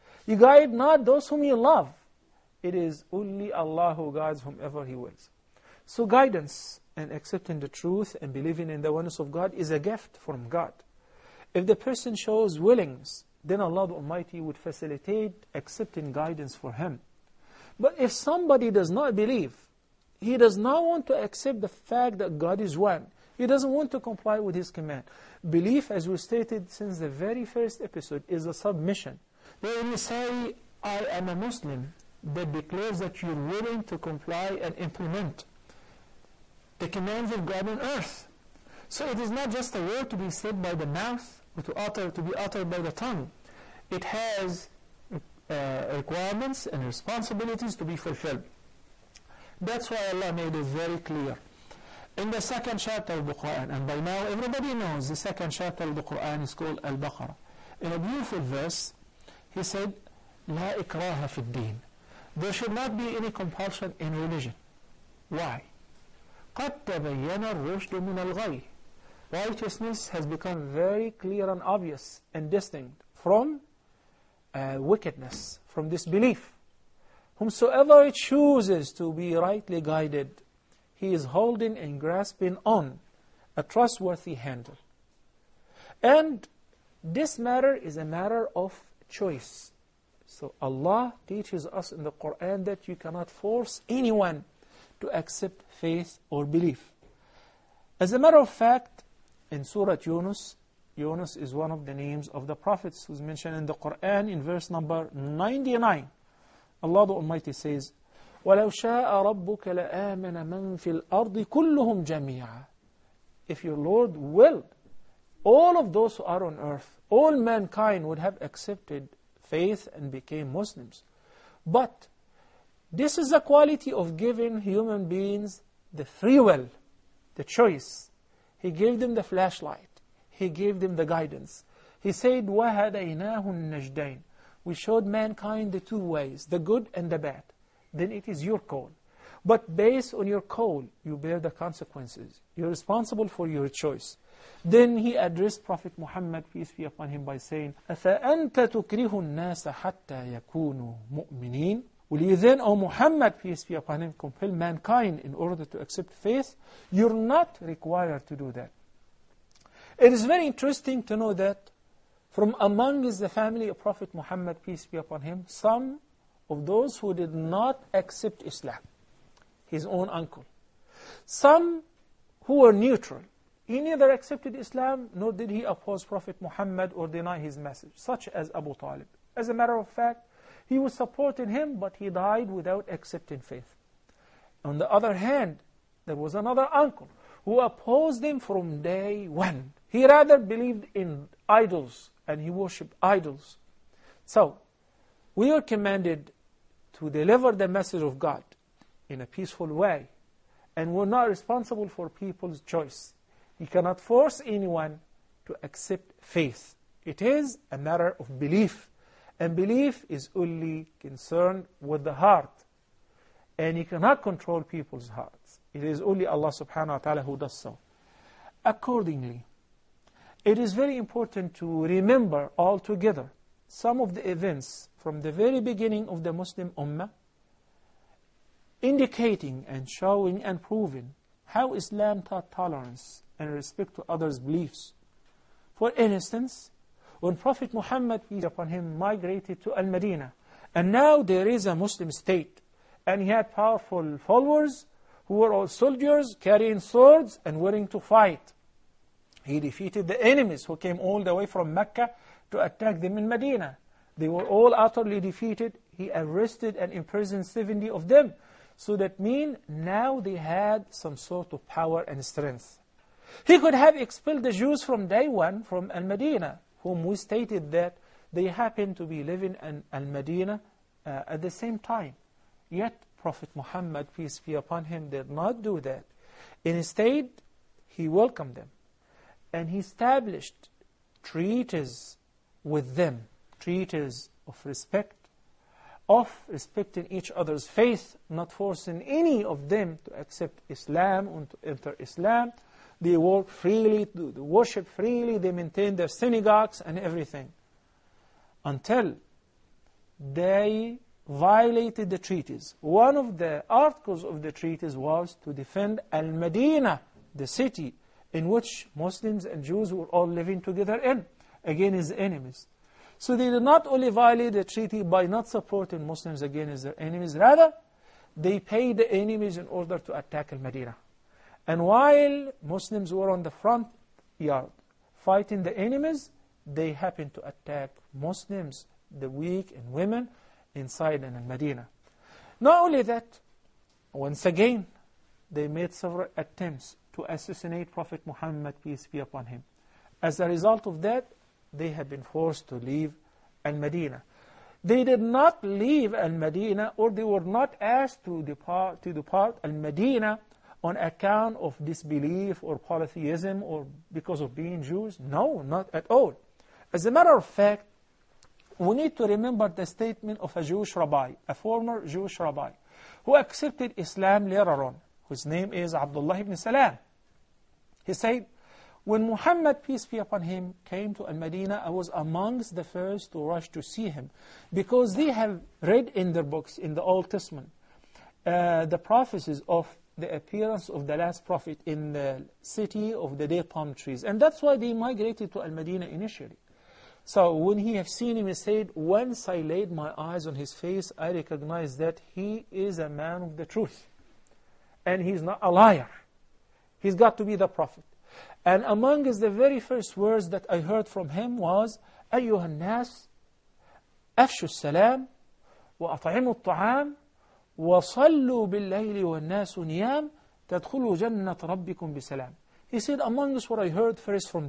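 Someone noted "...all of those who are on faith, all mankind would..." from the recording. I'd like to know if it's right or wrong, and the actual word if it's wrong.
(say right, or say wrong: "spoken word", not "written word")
wrong: "earth", not "faith".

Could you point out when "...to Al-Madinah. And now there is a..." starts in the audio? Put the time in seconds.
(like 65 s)
239 s.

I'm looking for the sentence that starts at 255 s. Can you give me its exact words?
He arrested and imprisoned 70 of them.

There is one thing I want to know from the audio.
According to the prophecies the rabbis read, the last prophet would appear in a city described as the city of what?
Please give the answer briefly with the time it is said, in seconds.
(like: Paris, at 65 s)
palm trees, at 383 s.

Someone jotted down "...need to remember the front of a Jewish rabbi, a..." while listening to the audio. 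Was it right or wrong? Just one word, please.
wrong.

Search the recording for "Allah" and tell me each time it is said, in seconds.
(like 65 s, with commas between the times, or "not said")
3 s, 13 s, 50 s, 90 s, 106 s, 216 s.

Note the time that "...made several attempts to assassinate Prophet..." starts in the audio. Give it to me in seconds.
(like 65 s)
335 s.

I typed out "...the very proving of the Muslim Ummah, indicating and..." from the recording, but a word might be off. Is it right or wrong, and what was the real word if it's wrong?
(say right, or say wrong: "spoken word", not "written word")
wrong: "beginning", not "proving".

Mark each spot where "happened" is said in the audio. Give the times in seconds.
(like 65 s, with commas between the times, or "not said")
268 s, 326 s.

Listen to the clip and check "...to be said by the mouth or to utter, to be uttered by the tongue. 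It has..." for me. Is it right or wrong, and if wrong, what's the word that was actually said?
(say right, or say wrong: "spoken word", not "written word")
right.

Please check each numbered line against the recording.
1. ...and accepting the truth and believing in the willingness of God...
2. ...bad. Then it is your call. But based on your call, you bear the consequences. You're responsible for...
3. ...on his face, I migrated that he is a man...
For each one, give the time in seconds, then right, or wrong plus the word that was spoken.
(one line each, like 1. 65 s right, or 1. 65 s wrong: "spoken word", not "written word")
1. 6 s wrong: "oneness", not "willingness"
2. 137 s right
3. 390 s wrong: "recognized", not "migrated".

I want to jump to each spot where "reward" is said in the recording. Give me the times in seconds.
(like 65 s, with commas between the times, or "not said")
not said.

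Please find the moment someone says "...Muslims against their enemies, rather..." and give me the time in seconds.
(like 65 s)
316 s.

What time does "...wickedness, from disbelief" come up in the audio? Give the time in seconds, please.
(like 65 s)
74 s.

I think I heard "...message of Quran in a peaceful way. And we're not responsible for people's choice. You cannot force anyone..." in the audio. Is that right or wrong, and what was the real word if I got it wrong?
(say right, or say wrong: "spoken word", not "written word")
wrong: "God", not "Quran".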